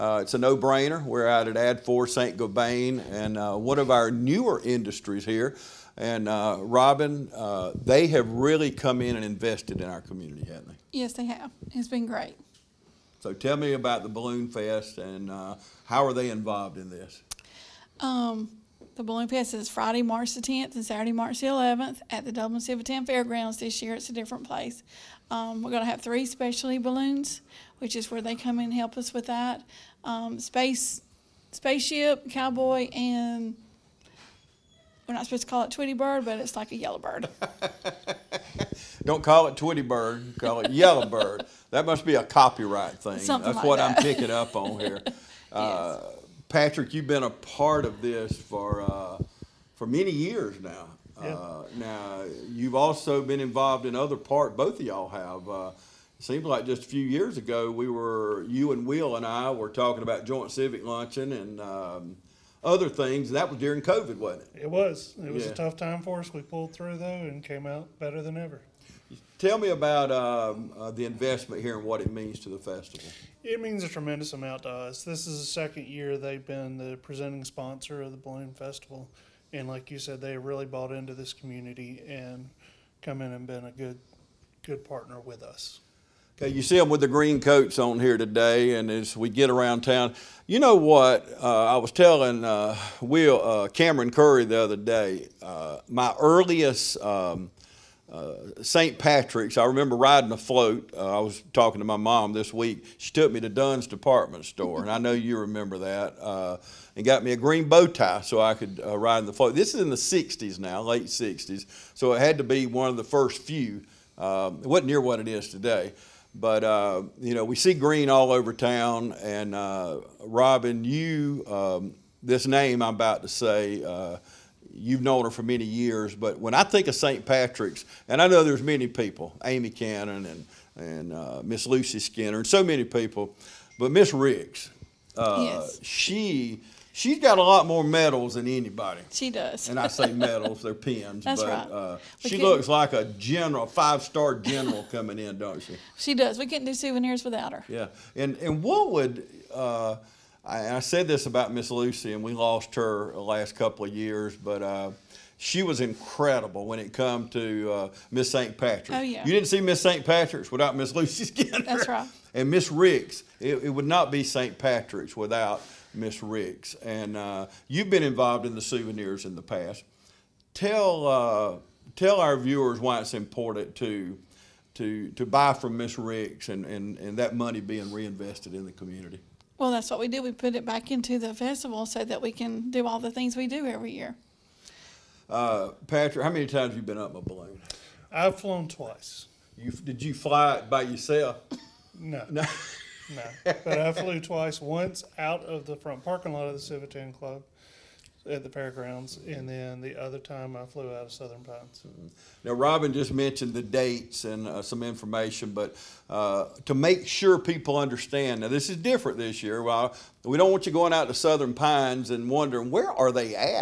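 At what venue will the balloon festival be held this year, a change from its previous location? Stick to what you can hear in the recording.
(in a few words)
Dublin Civitan Fairgrounds.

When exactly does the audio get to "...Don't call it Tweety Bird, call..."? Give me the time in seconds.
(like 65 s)
39 s.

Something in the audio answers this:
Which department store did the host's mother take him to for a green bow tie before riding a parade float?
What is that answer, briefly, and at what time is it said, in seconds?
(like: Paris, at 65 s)
Dunn's, at 103 s.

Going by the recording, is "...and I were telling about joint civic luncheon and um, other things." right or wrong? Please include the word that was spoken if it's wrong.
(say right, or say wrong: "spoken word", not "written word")
wrong: "talking", not "telling".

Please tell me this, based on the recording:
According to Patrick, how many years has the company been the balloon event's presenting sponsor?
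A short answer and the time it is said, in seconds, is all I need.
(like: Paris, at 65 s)
second year, at 75 s.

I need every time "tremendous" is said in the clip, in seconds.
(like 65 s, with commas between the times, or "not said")
73 s.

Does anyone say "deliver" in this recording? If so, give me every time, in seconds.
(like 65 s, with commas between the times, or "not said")
not said.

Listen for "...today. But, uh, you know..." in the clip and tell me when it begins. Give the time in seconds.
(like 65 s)
115 s.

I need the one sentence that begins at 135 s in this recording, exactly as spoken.
she, she's got a lot more medals than anybody.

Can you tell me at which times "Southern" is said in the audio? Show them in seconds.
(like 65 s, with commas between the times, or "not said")
201 s, 211 s.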